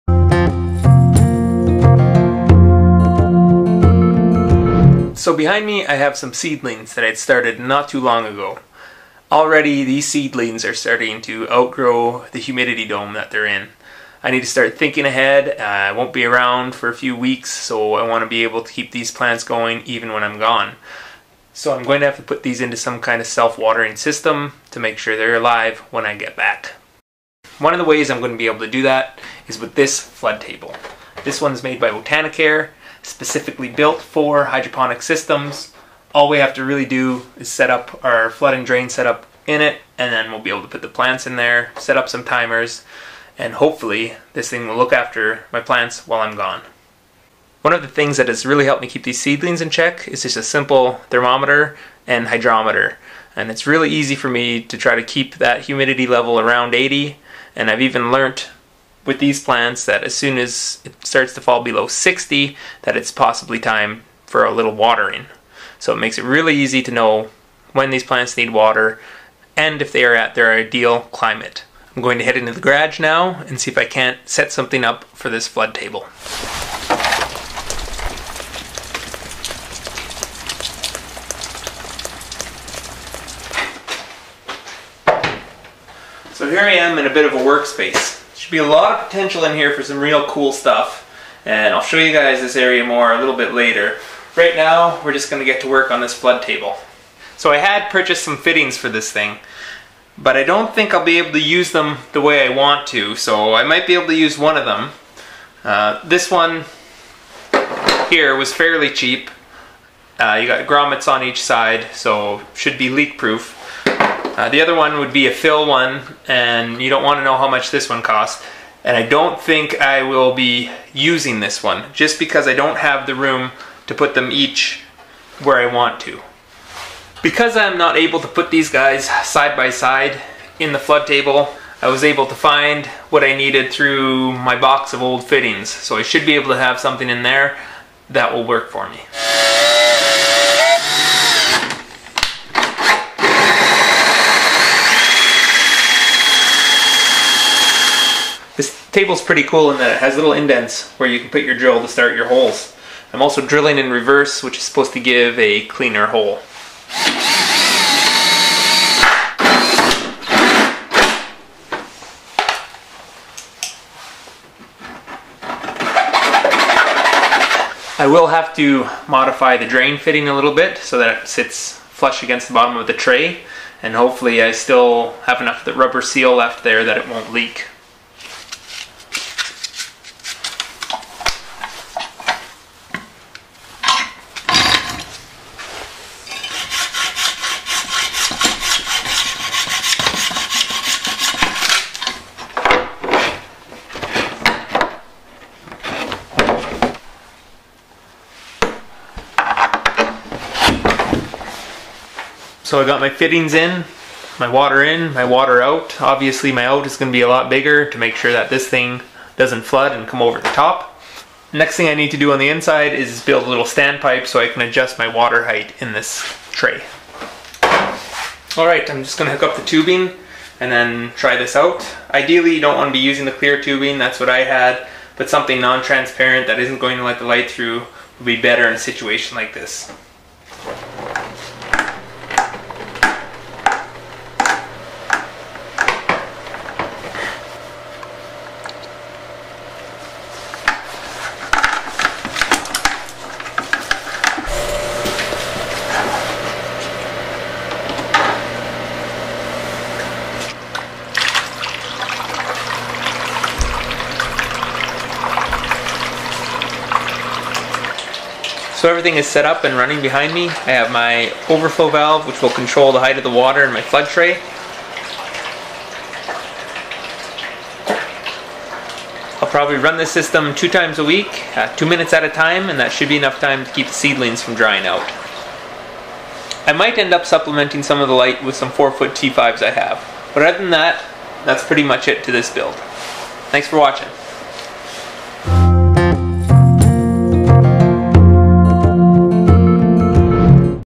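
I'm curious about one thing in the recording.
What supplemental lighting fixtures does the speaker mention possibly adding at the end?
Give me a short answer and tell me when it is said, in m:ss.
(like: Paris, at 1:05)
4-foot T5s, at 4:38.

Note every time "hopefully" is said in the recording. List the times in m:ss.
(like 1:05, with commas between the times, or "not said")
0:43, 2:53.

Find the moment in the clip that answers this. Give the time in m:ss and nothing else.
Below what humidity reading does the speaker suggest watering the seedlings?
1:01.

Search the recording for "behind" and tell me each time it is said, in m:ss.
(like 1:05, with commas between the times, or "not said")
0:05, 4:20.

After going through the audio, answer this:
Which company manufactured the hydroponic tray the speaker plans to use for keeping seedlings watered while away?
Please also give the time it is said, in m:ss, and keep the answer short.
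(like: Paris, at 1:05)
Botanicare, at 0:31.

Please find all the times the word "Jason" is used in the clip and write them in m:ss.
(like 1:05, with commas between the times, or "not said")
not said.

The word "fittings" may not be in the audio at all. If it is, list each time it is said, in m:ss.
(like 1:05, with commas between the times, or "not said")
1:38, 2:15, 2:49, 3:23.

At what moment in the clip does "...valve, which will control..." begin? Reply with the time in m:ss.
4:21.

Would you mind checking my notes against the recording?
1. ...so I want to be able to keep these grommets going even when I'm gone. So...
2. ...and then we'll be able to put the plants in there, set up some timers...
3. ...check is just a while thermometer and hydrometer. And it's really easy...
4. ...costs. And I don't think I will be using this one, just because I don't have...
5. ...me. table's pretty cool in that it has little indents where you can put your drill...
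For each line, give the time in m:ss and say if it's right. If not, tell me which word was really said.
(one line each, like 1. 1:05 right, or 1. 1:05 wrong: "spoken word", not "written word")
1. 0:17 wrong: "plants", not "grommets"
2. 0:39 right
3. 0:49 wrong: "simple", not "while"
4. 1:58 right
5. 2:18 right.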